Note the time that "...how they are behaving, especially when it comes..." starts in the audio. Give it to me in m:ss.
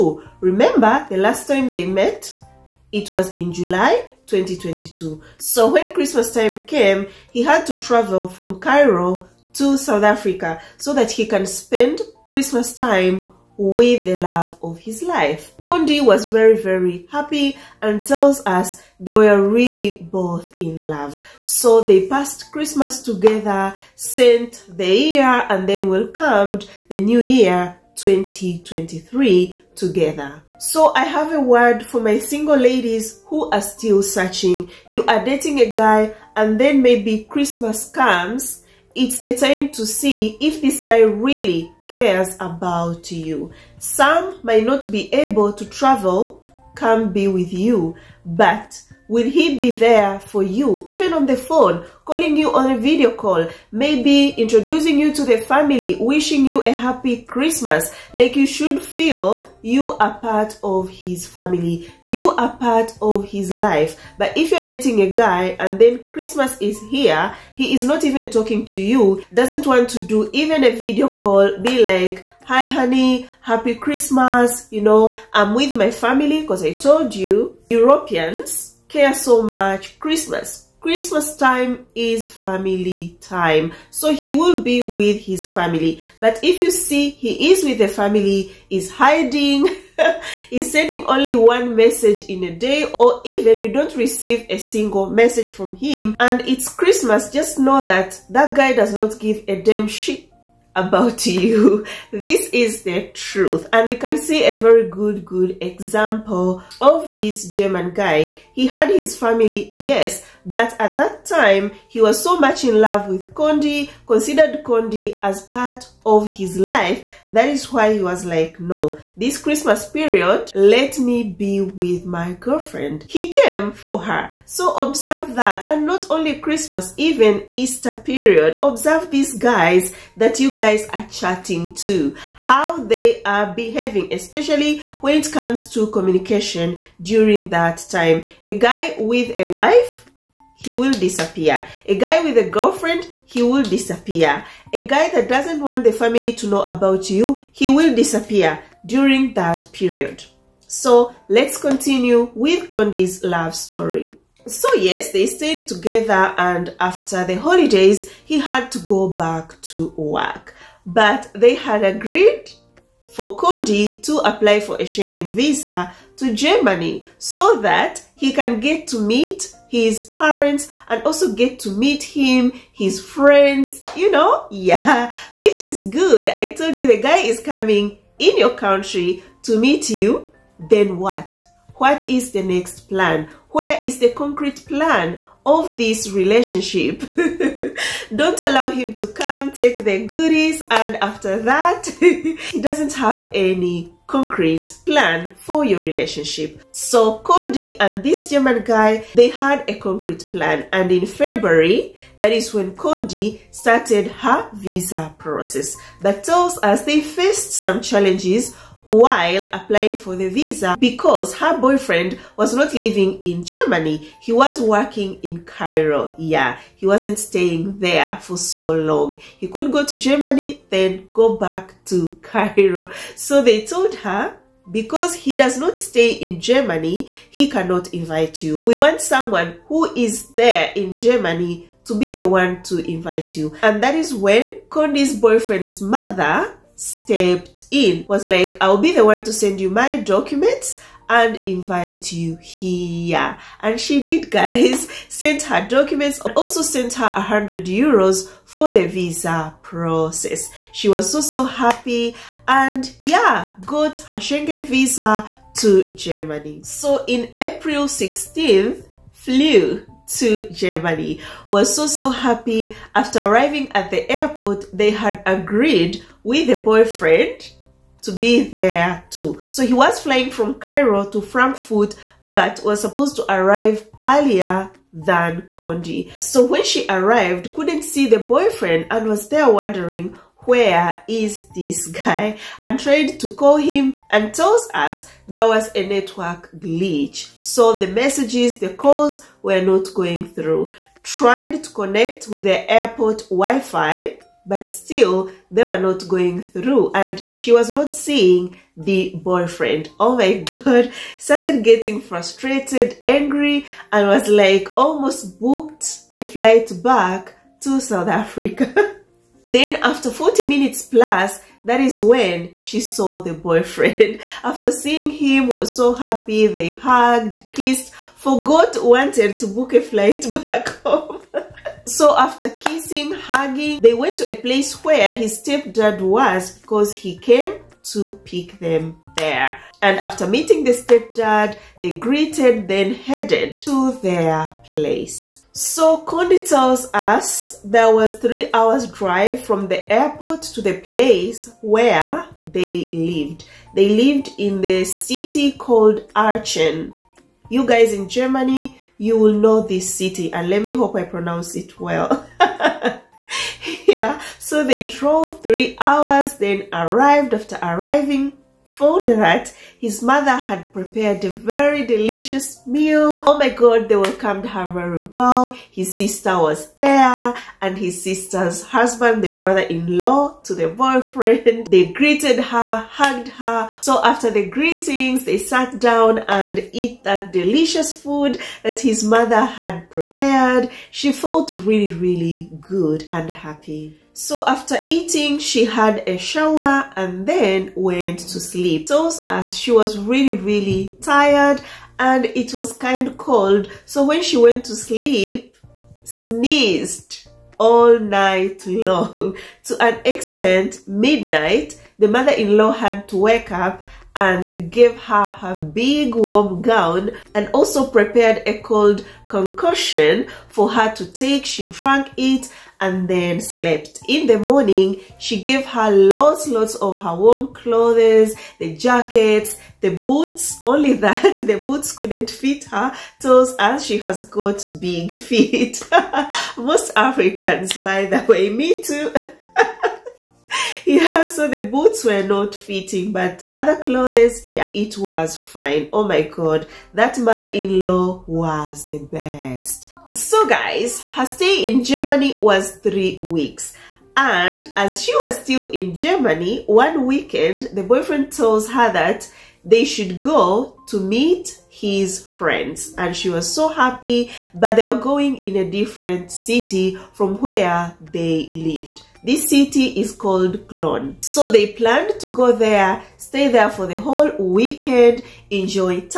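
2:12.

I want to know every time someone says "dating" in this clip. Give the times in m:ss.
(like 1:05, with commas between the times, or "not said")
0:35, 1:04.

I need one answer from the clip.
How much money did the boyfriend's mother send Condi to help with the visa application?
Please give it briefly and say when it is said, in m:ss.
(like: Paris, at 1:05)
100 euros, at 4:07.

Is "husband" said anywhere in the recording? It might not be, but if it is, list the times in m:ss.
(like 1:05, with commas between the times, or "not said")
6:08.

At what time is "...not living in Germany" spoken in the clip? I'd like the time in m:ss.
3:32.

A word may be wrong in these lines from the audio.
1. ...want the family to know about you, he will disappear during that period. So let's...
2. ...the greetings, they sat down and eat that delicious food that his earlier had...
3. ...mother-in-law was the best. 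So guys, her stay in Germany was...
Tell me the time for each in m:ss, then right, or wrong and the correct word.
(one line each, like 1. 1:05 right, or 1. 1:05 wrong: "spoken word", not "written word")
1. 2:25 right
2. 6:14 wrong: "mother", not "earlier"
3. 7:17 right.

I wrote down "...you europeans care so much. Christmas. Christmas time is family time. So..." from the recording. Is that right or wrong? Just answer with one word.
right.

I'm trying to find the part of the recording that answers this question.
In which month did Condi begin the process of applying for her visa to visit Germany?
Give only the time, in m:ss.
3:21.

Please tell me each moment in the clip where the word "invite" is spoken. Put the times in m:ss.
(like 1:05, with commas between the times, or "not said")
3:47, 3:52, 4:01.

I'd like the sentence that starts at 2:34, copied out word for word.
So yes, they stayed together and after the holidays, he had to go back to work.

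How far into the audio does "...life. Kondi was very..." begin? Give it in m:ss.
0:15.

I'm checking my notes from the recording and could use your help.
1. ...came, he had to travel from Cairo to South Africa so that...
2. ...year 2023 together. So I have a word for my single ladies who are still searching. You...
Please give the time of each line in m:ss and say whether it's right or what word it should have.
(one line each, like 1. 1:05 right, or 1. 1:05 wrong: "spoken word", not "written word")
1. 0:06 right
2. 0:27 right.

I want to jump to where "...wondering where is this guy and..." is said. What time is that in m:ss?
4:39.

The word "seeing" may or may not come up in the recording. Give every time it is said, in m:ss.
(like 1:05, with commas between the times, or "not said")
4:57, 5:14.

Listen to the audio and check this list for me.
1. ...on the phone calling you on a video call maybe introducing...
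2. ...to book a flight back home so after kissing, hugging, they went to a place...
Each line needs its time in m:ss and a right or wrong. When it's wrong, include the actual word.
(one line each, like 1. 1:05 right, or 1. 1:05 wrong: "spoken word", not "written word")
1. 0:51 right
2. 5:19 right.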